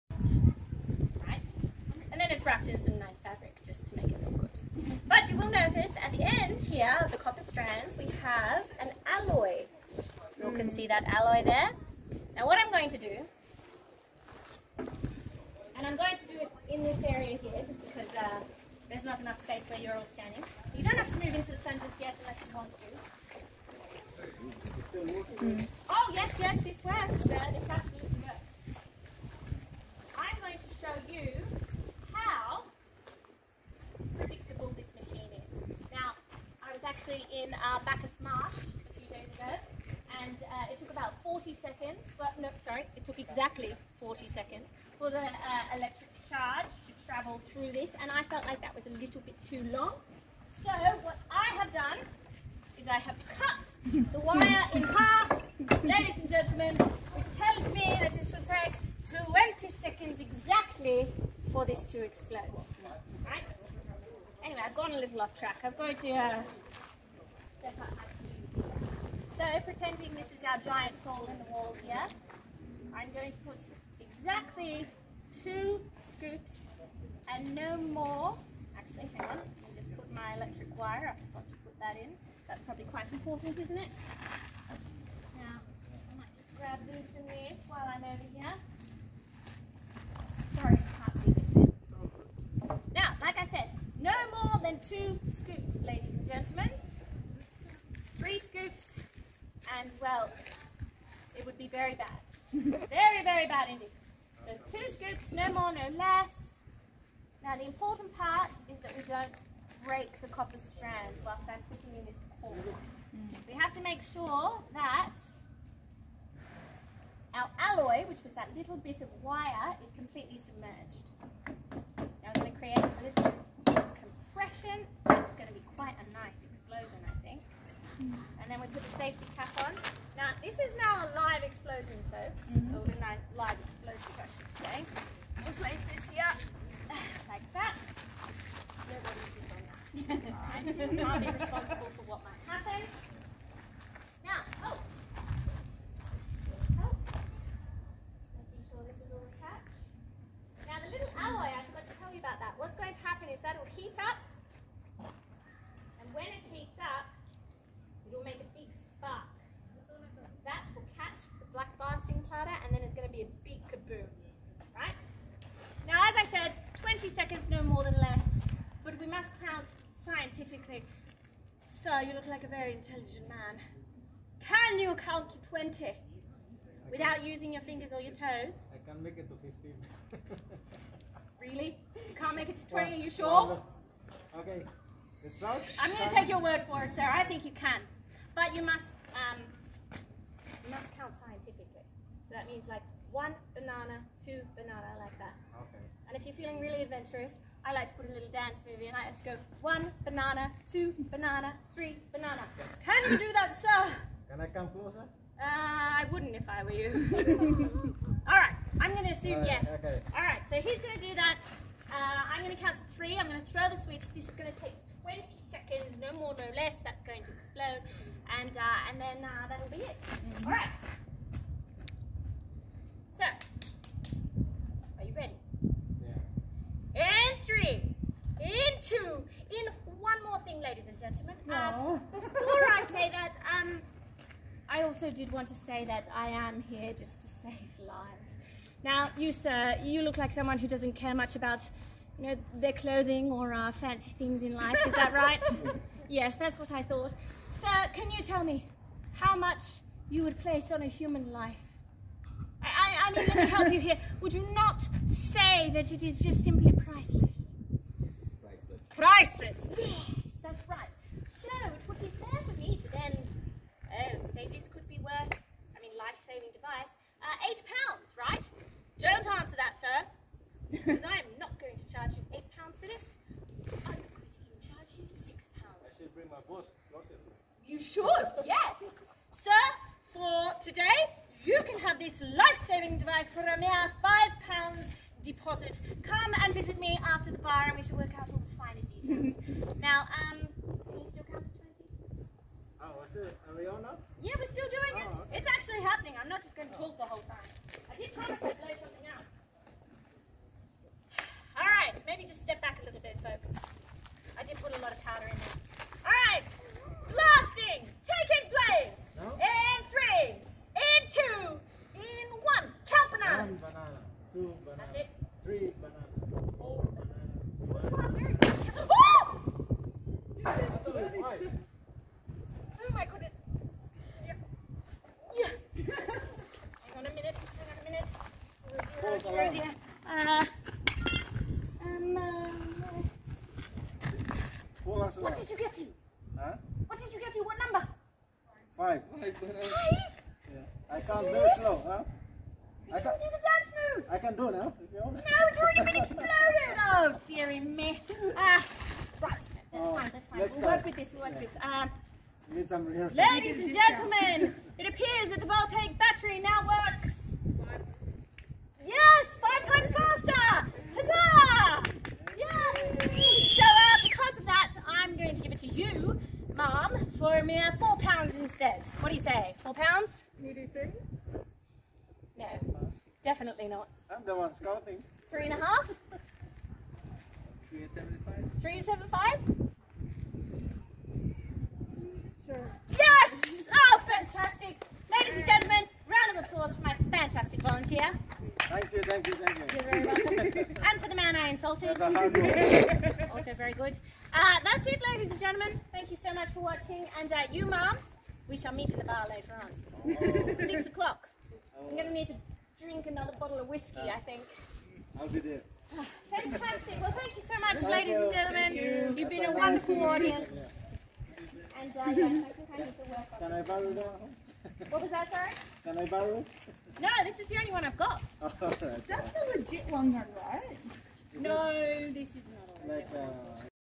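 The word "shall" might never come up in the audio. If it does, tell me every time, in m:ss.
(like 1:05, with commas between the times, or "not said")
4:47, 6:38.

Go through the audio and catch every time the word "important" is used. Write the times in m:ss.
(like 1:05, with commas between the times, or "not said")
1:23, 1:47.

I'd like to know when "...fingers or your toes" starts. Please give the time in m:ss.
2:57.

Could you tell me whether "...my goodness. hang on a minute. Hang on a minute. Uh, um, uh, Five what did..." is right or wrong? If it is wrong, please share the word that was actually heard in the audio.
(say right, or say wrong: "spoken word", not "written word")
wrong: "Falls", not "Five".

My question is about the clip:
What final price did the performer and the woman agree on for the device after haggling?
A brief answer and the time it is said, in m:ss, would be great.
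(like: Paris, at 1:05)
3.75 pounds, at 6:18.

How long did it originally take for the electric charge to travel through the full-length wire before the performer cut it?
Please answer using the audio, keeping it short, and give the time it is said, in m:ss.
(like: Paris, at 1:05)
40 seconds, at 0:43.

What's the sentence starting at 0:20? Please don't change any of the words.
You don't have to move into the sun just yet unless you want to.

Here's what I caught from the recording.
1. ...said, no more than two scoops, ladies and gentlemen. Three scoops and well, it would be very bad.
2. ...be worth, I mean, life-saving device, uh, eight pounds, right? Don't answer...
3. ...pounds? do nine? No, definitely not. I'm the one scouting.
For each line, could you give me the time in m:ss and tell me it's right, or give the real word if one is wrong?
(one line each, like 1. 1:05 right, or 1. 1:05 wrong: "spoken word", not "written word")
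1. 1:33 right
2. 4:24 right
3. 6:09 wrong: "three", not "nine".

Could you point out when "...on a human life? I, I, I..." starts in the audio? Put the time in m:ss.
4:10.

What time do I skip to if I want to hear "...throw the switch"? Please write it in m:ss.
3:33.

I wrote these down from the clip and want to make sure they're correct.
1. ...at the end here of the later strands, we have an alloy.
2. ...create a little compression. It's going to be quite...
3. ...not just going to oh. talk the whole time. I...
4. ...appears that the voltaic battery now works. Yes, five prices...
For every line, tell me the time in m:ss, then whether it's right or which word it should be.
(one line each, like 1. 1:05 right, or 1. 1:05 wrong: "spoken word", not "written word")
1. 0:06 wrong: "copper", not "later"
2. 2:02 right
3. 4:56 right
4. 5:54 wrong: "times", not "prices".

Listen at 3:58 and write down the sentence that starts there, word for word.
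Now, you, sir, you look like someone who doesn't care much about, you know, their clothing or uh, fancy things in life.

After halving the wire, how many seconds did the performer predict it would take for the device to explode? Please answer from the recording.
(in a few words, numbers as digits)
20 seconds.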